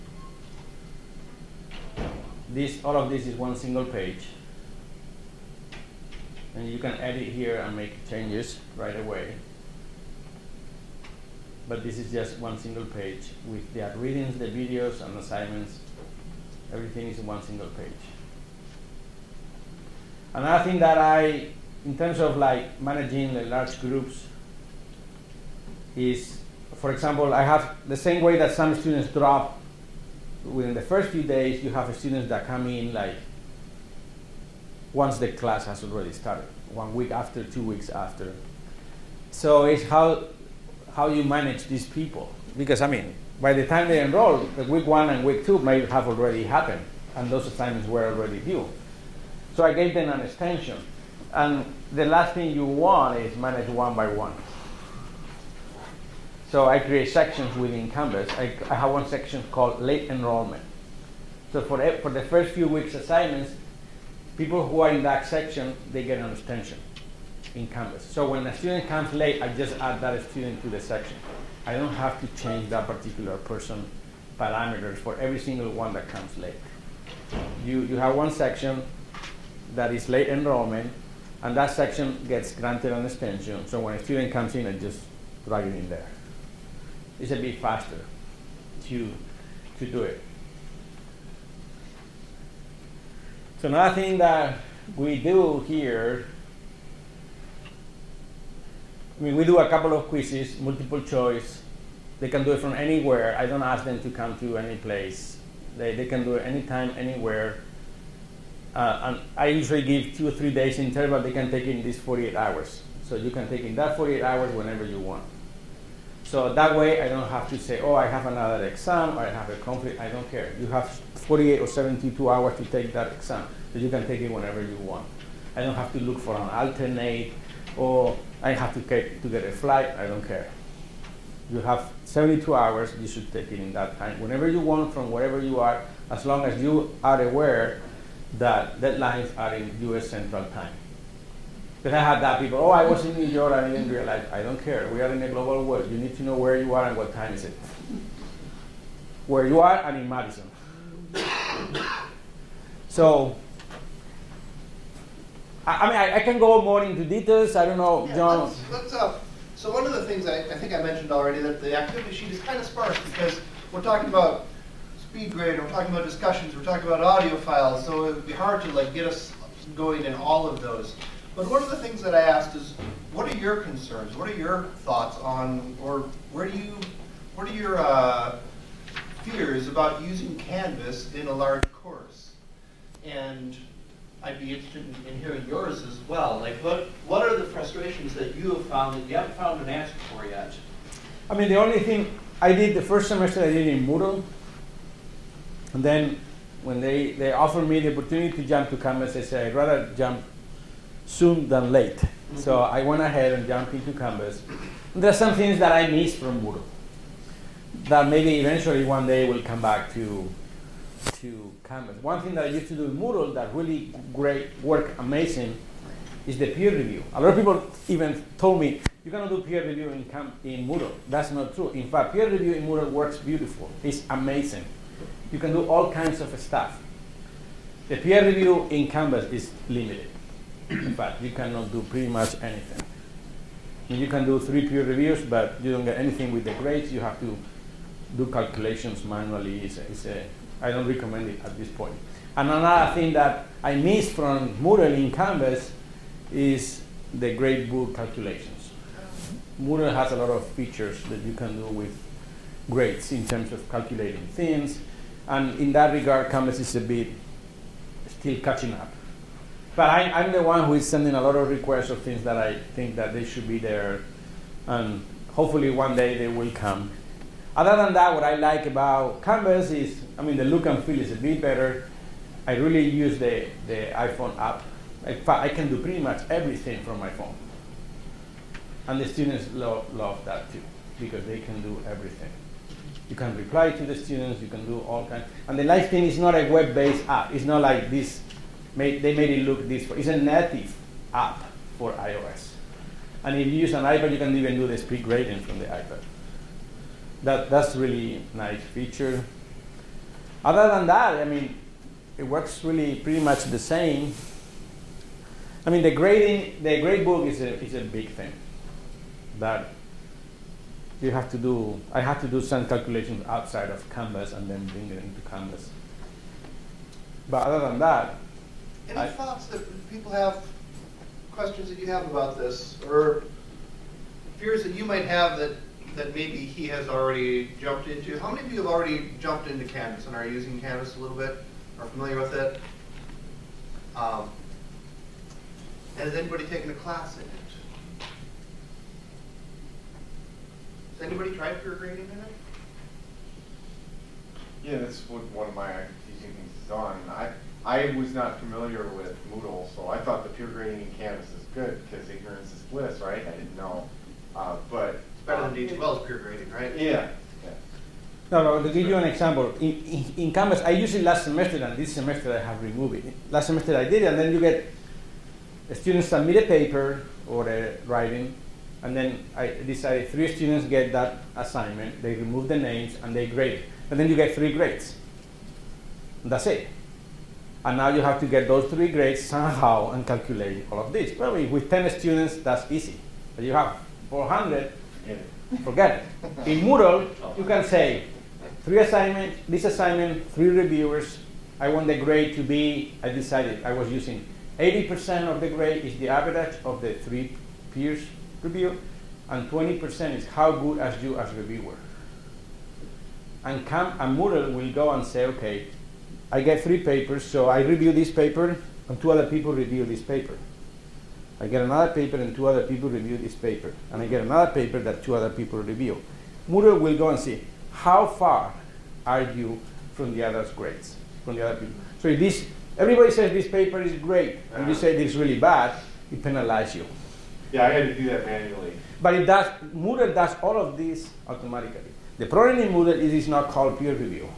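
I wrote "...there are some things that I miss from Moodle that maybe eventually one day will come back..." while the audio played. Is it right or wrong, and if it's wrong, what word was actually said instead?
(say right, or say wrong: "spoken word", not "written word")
right.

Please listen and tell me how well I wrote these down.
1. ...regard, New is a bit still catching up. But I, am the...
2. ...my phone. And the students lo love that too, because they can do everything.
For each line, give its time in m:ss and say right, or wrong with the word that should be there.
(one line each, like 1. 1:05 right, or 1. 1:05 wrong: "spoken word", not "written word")
1. 4:15 wrong: "Canvas", not "New"
2. 4:36 right.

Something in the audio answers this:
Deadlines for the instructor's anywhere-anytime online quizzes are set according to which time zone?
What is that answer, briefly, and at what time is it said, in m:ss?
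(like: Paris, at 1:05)
US Central Time, at 2:19.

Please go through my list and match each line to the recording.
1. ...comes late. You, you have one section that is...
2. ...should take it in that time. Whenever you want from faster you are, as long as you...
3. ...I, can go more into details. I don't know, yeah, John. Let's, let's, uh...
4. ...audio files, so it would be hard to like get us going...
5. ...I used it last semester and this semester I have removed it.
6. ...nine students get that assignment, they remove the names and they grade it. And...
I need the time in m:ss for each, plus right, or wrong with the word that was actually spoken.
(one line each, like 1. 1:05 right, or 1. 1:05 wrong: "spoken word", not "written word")
1. 1:16 right
2. 2:13 wrong: "wherever", not "faster"
3. 2:36 right
4. 2:47 right
5. 6:00 right
6. 6:10 wrong: "three", not "nine".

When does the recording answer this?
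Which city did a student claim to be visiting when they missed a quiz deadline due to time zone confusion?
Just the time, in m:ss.
2:23.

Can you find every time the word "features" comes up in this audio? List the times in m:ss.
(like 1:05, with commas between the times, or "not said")
4:10, 4:58.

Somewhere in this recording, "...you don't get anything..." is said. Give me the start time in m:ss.
3:55.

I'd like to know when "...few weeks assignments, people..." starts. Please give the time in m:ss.
1:02.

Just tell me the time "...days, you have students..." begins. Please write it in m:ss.
0:31.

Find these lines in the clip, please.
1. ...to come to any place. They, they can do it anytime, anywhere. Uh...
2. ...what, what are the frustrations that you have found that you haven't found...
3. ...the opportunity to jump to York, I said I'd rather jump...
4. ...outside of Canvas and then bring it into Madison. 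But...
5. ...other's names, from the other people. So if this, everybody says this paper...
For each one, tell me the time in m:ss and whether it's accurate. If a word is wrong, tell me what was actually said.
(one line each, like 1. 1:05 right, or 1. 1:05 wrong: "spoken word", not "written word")
1. 1:44 right
2. 3:06 right
3. 3:17 wrong: "Canvas", not "York"
4. 5:13 wrong: "Canvas", not "Madison"
5. 7:00 wrong: "grades", not "names".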